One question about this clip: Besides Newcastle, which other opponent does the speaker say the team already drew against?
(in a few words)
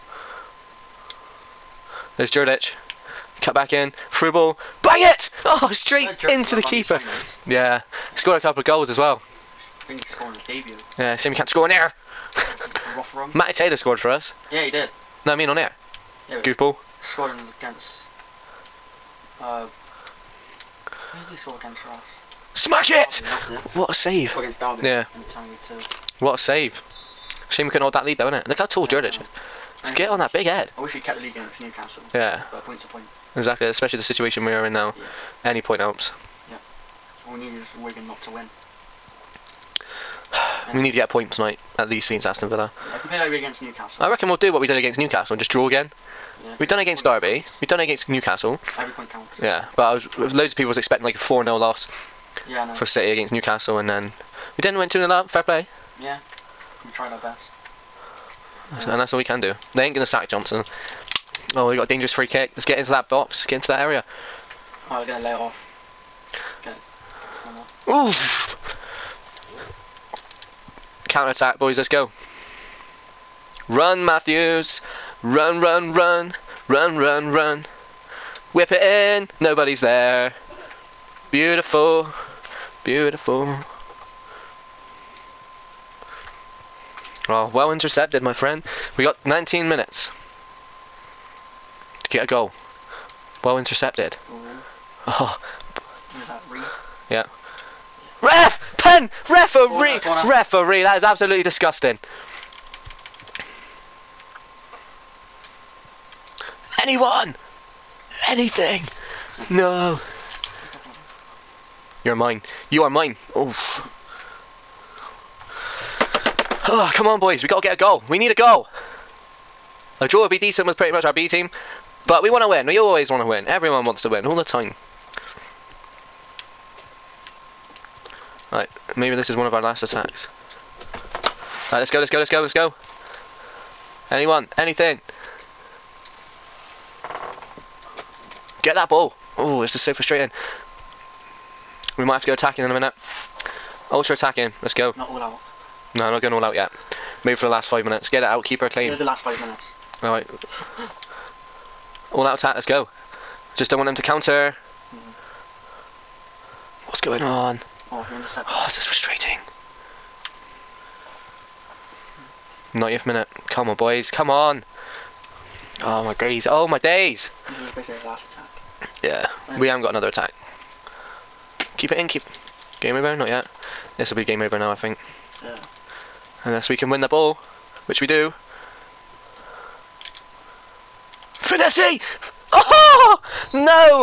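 Derby.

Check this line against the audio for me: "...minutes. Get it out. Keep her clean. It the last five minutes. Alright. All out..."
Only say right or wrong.
right.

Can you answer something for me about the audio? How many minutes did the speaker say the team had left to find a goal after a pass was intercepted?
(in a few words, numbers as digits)
19.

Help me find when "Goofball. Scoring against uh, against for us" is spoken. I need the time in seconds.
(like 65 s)
16 s.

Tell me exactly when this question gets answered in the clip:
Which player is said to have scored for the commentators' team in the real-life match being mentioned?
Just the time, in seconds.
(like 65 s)
13 s.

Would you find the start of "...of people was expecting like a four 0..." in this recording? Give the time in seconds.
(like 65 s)
50 s.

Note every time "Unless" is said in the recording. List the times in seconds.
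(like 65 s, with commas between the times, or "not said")
176 s.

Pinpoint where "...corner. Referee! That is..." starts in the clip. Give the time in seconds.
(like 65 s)
100 s.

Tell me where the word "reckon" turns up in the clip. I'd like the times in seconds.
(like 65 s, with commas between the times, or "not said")
44 s.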